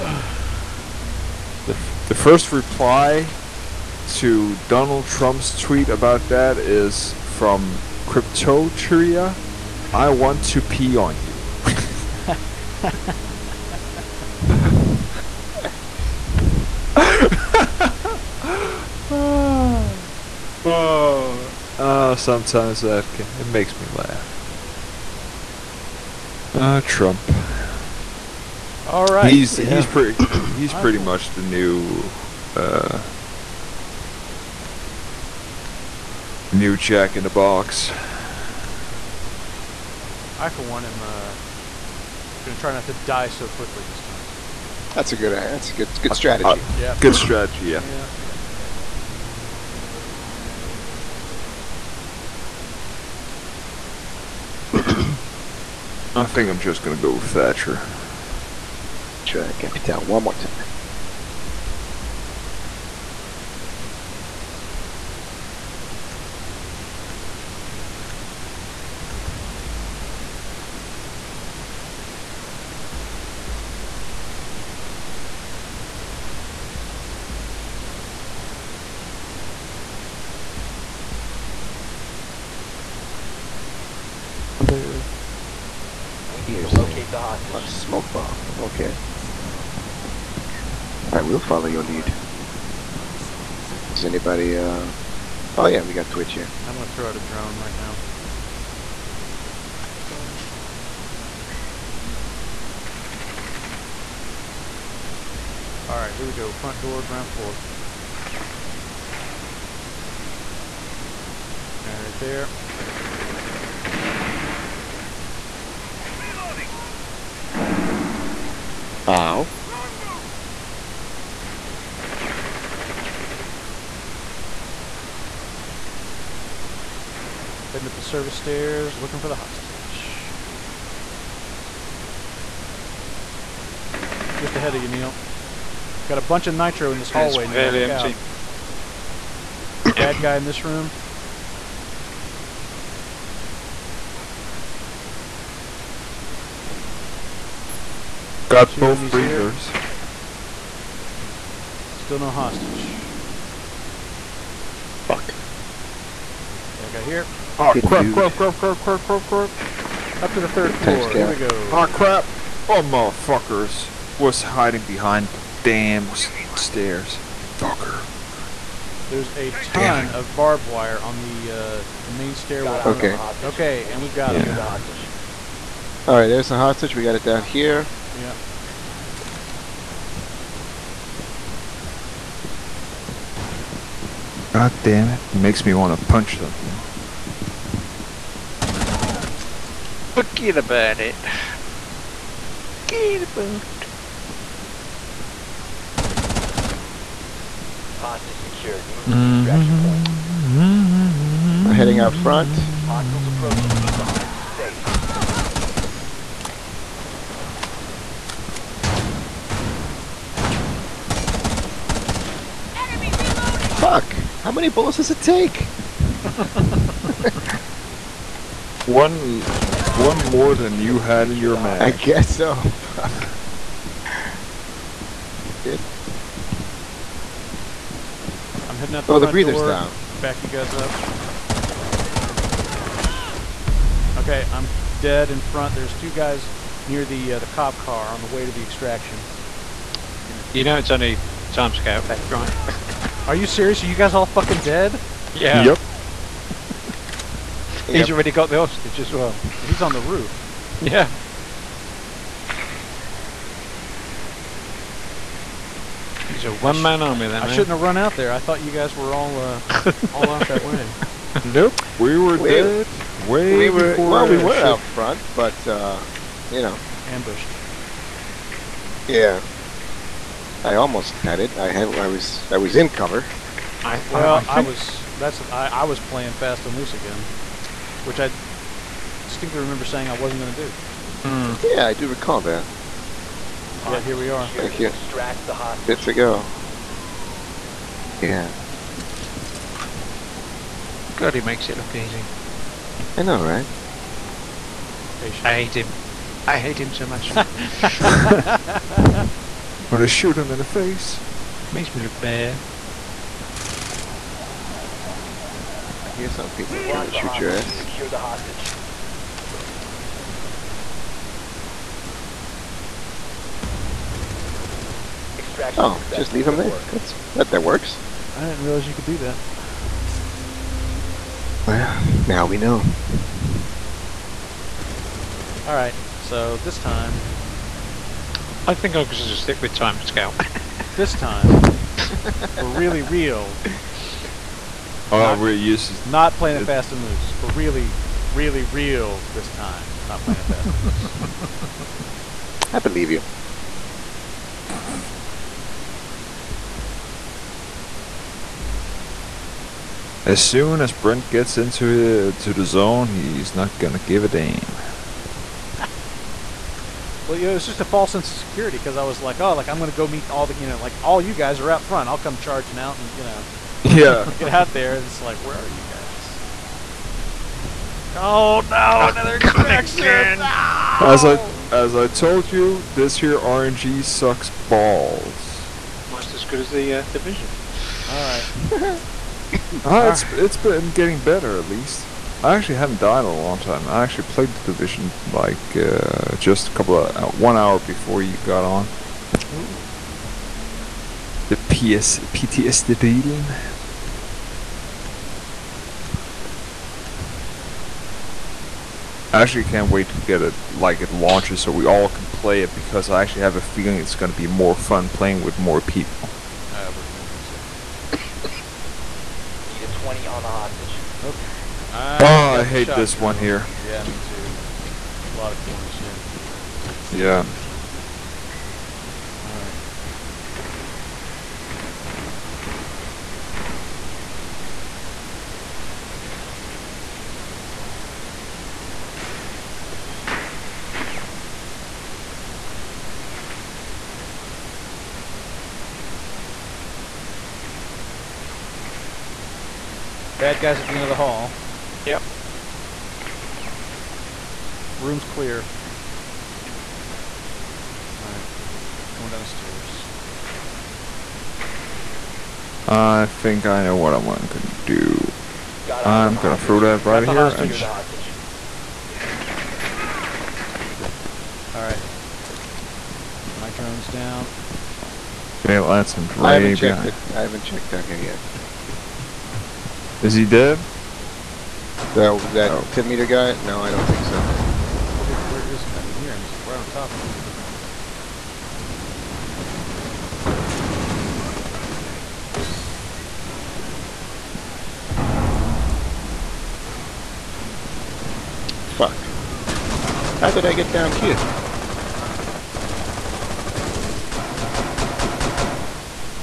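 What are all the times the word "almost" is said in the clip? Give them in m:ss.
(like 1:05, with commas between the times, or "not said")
4:30, 6:16.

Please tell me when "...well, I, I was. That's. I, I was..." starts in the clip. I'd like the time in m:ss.
4:34.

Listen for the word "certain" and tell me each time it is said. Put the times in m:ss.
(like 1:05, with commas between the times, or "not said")
not said.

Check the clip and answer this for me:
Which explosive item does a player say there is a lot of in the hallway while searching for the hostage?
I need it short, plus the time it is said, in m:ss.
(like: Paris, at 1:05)
Nitro, at 2:16.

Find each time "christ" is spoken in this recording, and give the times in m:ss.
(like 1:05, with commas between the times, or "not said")
not said.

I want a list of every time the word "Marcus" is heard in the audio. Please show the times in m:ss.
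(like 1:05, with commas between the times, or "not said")
not said.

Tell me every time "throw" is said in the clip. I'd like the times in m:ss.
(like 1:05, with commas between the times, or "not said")
1:36, 7:36.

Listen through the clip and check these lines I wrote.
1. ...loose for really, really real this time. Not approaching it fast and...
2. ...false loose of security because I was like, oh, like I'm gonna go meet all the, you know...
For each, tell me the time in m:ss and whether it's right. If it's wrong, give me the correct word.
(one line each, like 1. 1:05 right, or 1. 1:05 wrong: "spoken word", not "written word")
1. 5:37 wrong: "playing", not "approaching"
2. 5:57 wrong: "sense", not "loose".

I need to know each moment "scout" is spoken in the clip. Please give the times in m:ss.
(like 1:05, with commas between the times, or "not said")
4:01, 5:30.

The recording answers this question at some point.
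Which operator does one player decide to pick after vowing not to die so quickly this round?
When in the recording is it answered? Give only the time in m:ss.
0:57.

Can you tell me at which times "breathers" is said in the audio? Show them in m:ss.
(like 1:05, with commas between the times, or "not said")
2:29, 3:49.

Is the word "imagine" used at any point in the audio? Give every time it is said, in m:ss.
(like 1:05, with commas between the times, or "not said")
6:47.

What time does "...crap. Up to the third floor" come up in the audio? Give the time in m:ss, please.
2:39.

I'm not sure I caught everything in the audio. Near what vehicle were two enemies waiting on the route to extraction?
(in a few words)
Cop car.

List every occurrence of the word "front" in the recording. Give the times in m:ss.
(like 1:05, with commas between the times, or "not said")
1:46, 3:22, 3:55, 4:24, 6:01.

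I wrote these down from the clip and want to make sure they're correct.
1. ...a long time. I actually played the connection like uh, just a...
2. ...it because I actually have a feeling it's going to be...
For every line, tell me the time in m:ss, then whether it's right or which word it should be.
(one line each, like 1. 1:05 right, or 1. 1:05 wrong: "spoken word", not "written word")
1. 6:23 wrong: "division", not "connection"
2. 6:42 right.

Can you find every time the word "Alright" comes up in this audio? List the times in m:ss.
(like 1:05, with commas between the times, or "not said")
1:45, 6:18, 6:59, 7:28, 7:41.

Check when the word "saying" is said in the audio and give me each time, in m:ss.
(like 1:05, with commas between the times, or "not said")
4:39.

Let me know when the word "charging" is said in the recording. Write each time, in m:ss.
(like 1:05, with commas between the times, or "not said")
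6:02.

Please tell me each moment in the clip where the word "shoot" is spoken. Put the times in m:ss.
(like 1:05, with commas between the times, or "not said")
5:00, 5:07.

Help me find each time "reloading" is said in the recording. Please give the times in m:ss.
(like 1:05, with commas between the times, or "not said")
3:33.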